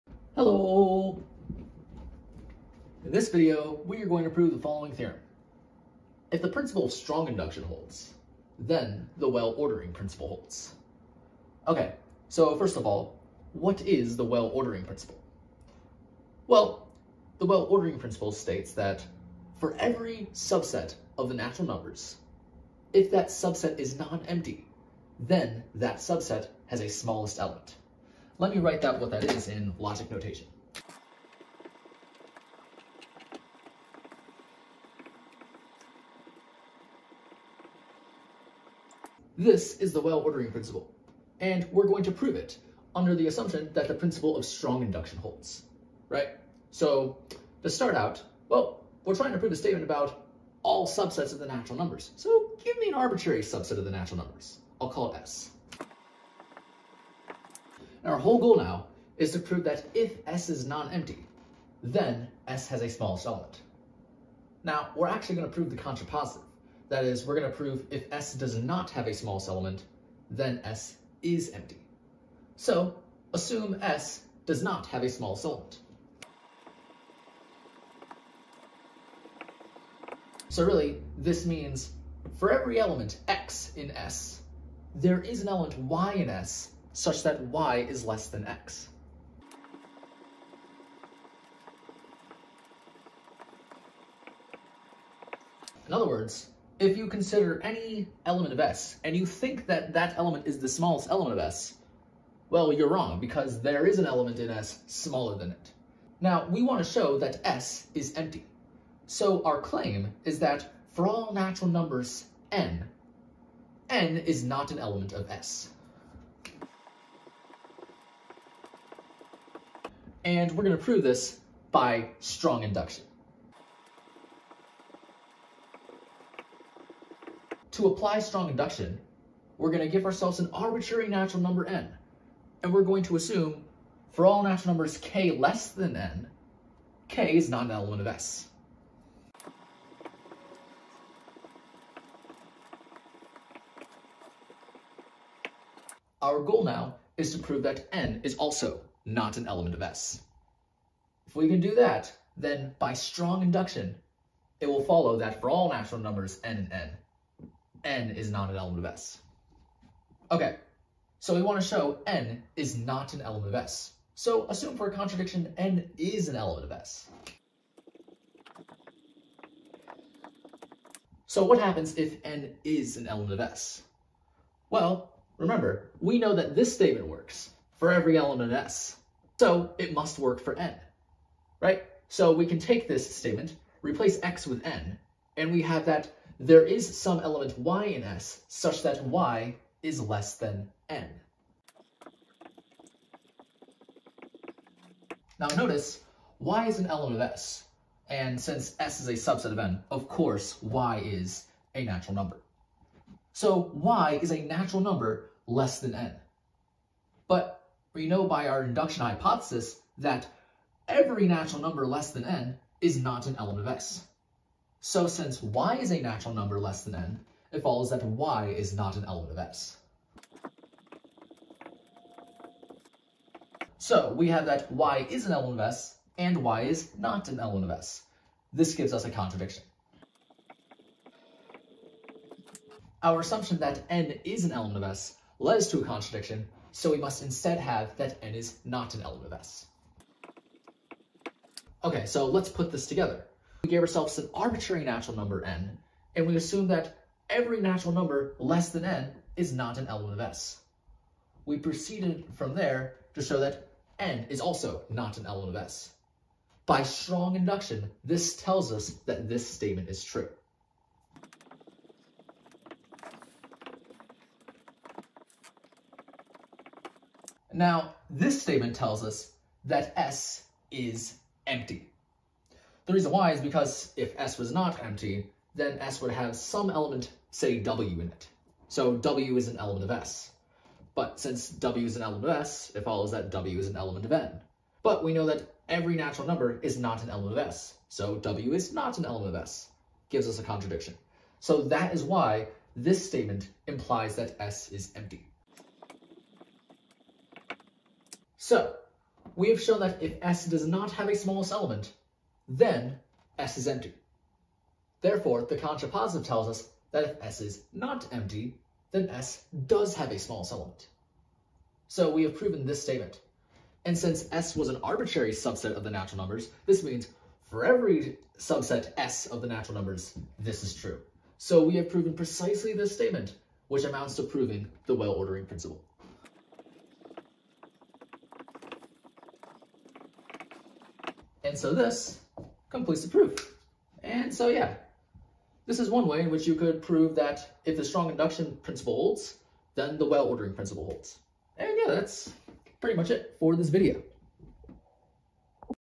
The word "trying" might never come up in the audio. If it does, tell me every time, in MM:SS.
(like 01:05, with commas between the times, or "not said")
00:49.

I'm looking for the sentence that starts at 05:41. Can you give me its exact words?
And yeah, that's pretty much it for this video.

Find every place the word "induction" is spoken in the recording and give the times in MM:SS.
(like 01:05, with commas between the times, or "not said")
00:07, 00:44, 02:02, 02:08, 02:33, 03:28, 04:17, 05:38.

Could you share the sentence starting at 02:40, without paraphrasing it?
Okay, so we want to show n is not an element of S.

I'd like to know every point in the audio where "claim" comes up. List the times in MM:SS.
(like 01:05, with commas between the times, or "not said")
01:49.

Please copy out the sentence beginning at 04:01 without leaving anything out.
Okay, so let's put this together.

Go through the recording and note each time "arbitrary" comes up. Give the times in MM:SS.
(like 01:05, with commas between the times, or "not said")
00:52, 02:10, 04:04, 05:14.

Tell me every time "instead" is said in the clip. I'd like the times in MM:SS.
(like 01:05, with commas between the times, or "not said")
03:57.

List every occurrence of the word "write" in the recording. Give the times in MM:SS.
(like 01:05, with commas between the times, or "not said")
00:28.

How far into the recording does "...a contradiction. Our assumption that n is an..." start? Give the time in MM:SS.
03:49.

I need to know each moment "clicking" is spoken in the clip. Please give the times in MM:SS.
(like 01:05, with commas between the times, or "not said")
not said.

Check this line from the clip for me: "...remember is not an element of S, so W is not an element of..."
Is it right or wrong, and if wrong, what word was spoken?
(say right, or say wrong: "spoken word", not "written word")
wrong: "number", not "remember".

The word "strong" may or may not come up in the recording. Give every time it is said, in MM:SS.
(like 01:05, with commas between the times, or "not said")
00:06, 00:44, 02:02, 02:08, 02:32, 04:16, 05:37.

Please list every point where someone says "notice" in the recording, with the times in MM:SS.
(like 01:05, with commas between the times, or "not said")
03:15.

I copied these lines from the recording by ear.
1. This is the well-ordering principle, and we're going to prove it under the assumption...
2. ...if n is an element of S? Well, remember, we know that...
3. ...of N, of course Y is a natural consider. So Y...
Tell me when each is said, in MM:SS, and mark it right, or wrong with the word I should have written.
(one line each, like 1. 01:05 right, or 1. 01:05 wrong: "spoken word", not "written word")
1. 00:39 right
2. 02:51 right
3. 03:19 wrong: "number", not "consider".